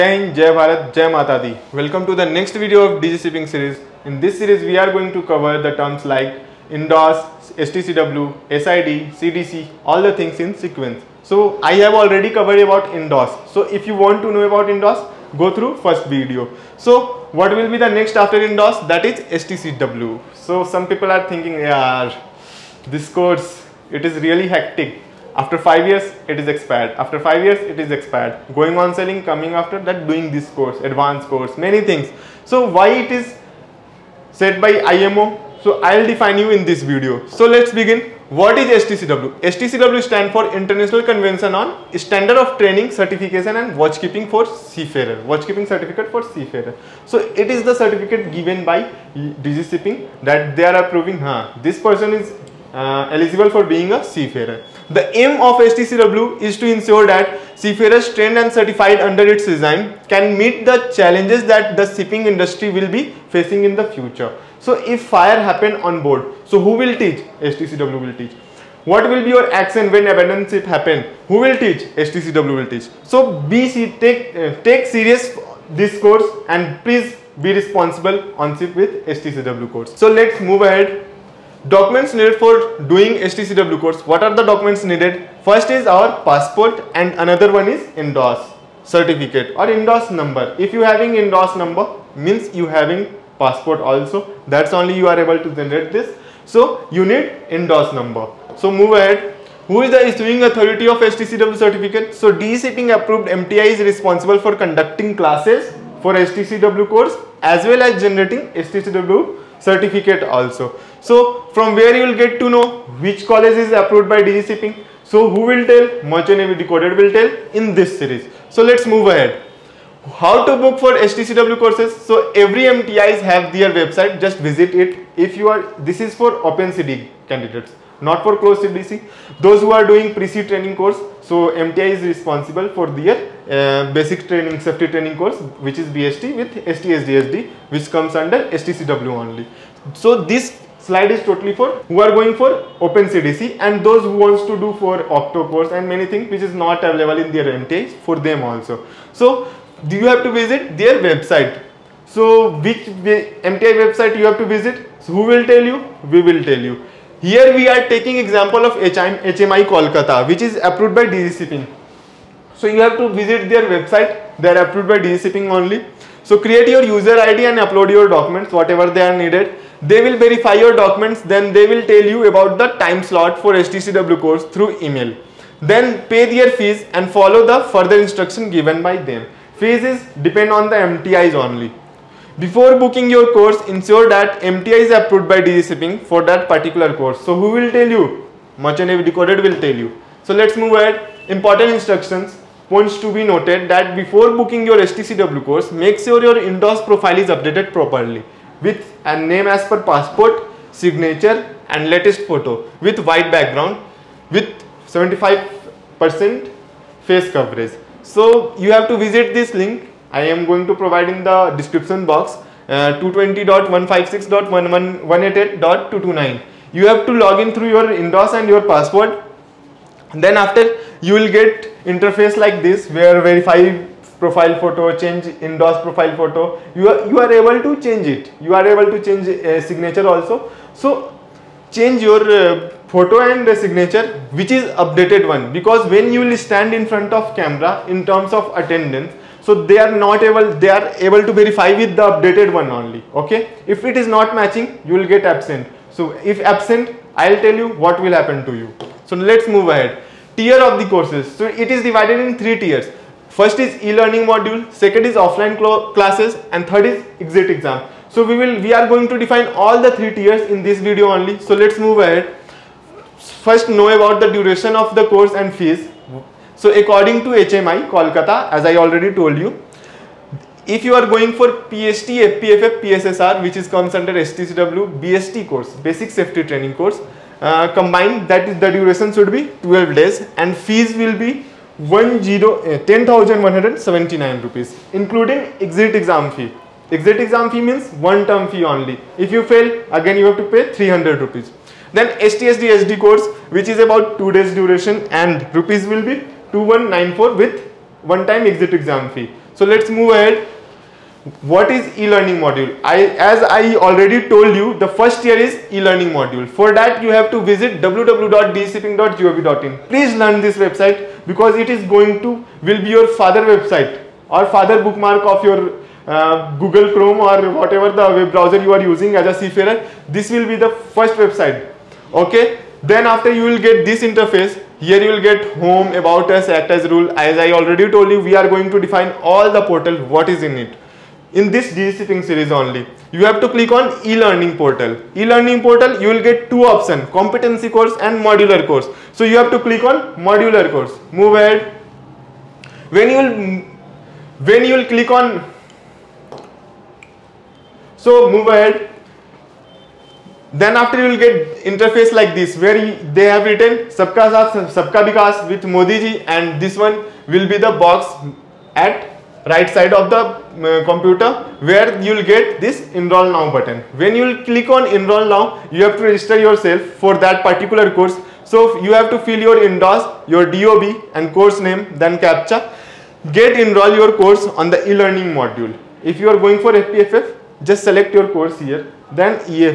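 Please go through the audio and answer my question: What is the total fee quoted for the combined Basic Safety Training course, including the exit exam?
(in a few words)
10,179 rupees.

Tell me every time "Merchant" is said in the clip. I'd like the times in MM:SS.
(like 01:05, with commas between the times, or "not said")
01:56, 03:08.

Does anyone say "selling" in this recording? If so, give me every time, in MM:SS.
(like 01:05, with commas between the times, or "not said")
00:28.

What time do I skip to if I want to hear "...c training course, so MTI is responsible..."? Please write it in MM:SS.
02:10.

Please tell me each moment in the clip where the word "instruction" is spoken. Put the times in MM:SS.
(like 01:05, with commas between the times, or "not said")
02:57, 03:11.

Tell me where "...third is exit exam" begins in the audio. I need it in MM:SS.
04:16.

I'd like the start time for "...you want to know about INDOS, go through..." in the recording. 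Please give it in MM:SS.
00:13.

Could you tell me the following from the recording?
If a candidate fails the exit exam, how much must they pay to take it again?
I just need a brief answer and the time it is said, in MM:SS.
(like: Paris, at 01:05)
300 rupees, at 04:50.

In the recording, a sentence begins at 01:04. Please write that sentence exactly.
So if fire happen on board, so who will teach?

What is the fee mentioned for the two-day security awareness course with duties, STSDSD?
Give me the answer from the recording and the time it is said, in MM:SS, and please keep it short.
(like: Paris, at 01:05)
2194 rupees, at 04:56.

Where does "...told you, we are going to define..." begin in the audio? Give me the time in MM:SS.
05:27.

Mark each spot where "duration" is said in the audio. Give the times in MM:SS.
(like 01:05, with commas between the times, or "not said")
04:24, 04:38, 04:54.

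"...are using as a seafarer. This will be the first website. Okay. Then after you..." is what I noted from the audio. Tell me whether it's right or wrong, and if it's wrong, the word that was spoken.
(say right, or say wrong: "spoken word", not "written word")
right.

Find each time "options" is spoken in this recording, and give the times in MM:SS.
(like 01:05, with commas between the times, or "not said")
05:36.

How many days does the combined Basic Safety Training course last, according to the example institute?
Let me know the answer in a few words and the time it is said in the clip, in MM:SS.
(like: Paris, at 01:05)
12 days, at 04:39.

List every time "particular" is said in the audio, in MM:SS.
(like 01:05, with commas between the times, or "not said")
03:06, 06:07.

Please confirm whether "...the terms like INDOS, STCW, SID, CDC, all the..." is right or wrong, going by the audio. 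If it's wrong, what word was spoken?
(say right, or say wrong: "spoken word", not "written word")
right.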